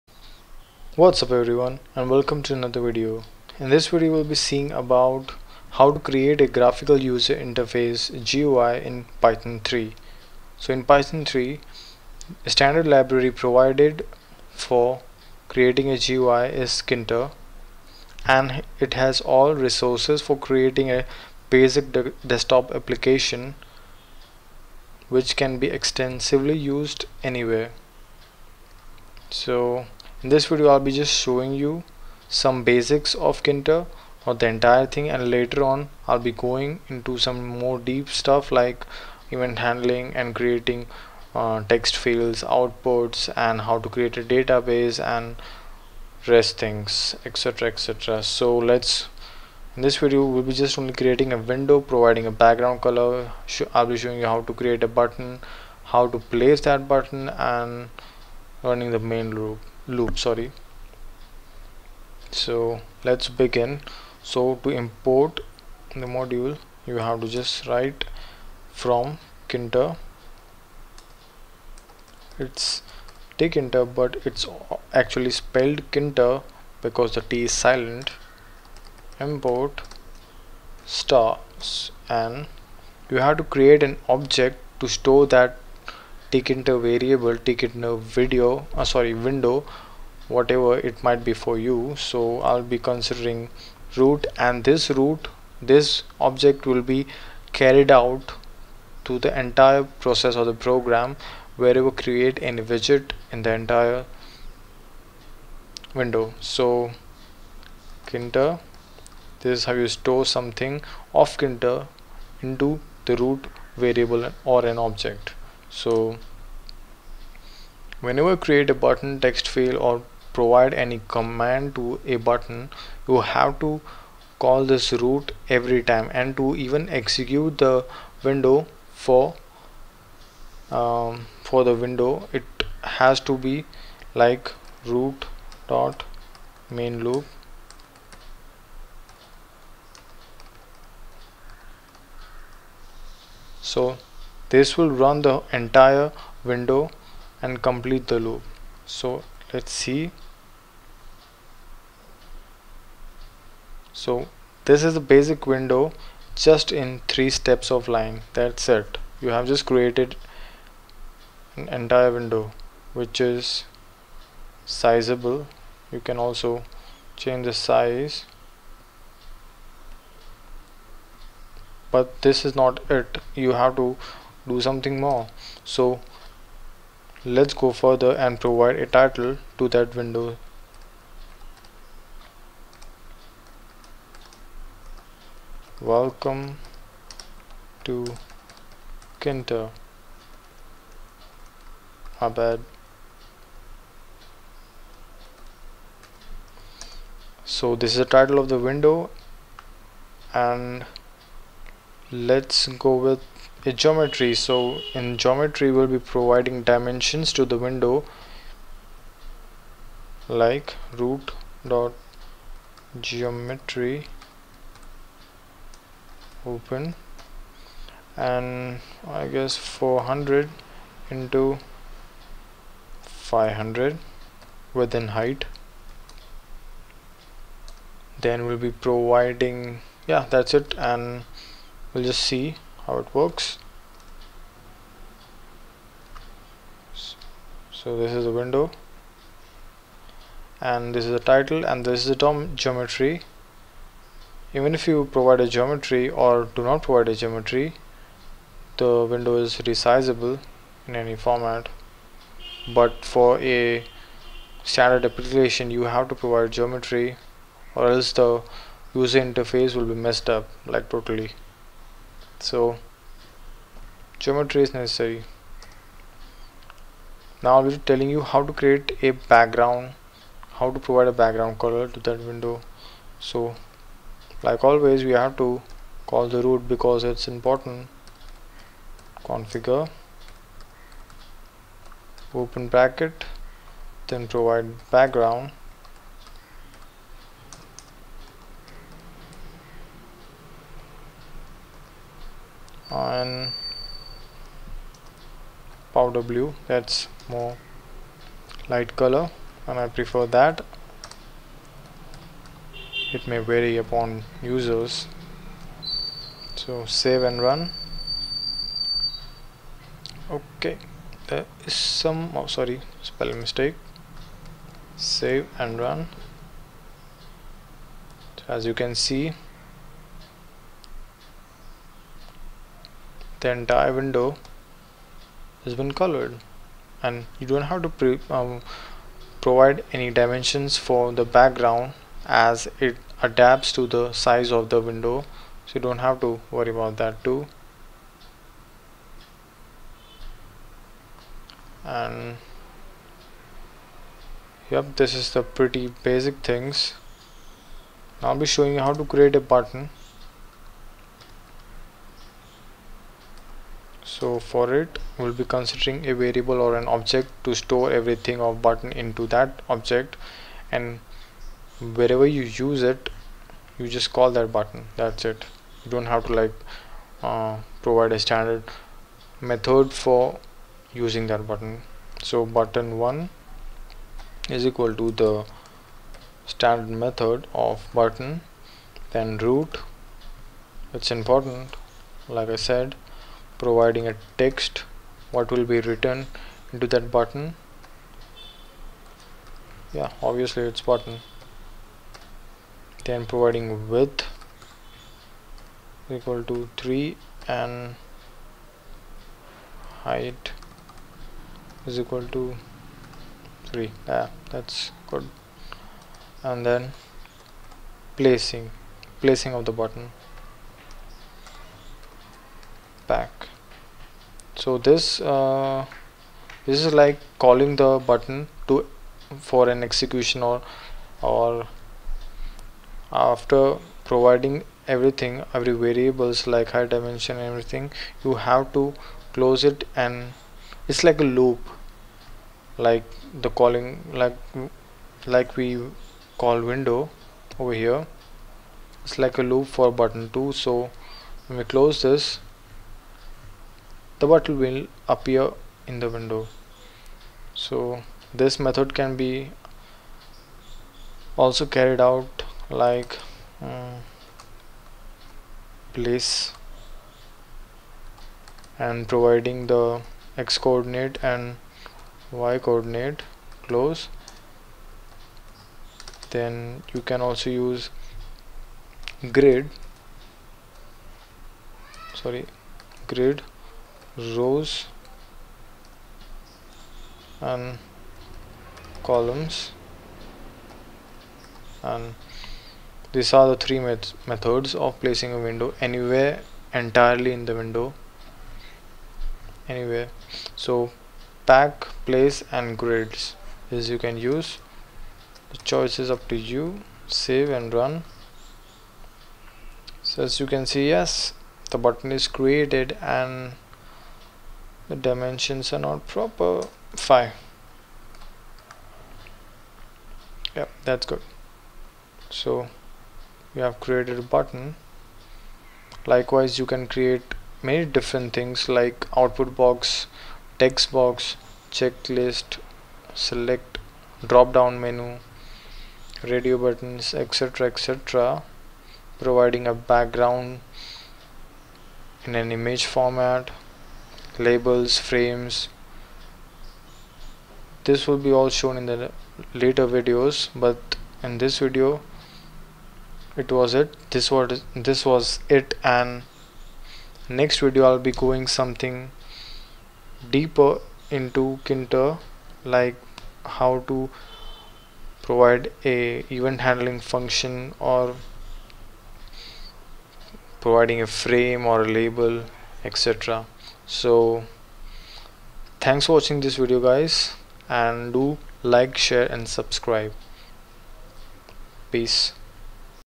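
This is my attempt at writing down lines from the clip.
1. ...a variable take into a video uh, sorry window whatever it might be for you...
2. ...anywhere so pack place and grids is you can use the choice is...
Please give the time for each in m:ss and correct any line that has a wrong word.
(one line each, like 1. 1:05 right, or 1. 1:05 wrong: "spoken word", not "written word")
1. 1:26 right
2. 8:09 right.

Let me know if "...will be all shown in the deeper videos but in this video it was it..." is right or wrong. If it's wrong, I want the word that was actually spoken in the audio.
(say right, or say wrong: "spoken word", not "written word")
wrong: "later", not "deeper".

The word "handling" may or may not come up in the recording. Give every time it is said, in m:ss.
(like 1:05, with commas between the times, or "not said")
0:39, 9:16.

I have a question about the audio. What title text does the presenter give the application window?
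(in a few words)
Welcome to Kinter.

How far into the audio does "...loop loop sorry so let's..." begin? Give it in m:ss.
0:59.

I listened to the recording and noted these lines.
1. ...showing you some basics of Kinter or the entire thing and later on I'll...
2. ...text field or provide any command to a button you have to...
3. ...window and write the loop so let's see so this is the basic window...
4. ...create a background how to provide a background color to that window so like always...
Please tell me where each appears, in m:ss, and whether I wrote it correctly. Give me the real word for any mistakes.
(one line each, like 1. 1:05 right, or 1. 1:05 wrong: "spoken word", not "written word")
1. 0:31 right
2. 1:59 right
3. 2:26 wrong: "complete", not "write"
4. 4:28 right.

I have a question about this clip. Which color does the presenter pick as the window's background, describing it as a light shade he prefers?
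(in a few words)
powder blue.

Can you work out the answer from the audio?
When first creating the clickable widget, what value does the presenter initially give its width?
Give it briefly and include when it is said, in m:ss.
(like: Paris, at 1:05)
3, at 6:33.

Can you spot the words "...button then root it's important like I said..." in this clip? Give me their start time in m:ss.
6:17.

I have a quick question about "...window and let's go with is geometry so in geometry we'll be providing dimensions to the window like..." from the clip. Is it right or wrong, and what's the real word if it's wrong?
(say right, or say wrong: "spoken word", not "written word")
right.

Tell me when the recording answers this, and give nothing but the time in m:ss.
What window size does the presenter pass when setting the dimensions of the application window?
3:39.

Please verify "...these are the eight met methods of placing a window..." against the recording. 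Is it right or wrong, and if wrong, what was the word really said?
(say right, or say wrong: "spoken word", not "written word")
wrong: "three", not "eight".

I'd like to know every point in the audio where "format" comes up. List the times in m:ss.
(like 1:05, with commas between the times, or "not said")
4:11, 8:52.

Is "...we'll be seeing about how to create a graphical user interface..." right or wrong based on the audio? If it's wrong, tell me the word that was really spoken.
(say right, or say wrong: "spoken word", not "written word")
right.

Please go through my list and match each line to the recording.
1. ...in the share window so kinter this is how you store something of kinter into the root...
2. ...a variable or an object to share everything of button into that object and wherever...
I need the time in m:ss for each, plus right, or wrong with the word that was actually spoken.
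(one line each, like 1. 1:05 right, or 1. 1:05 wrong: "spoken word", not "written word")
1. 1:43 wrong: "entire", not "share"
2. 5:56 wrong: "store", not "share".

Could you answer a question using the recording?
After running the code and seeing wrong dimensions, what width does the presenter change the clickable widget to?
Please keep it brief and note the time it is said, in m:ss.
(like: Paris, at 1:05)
5, at 8:27.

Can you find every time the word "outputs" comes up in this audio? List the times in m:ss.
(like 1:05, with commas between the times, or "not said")
0:42, 8:39.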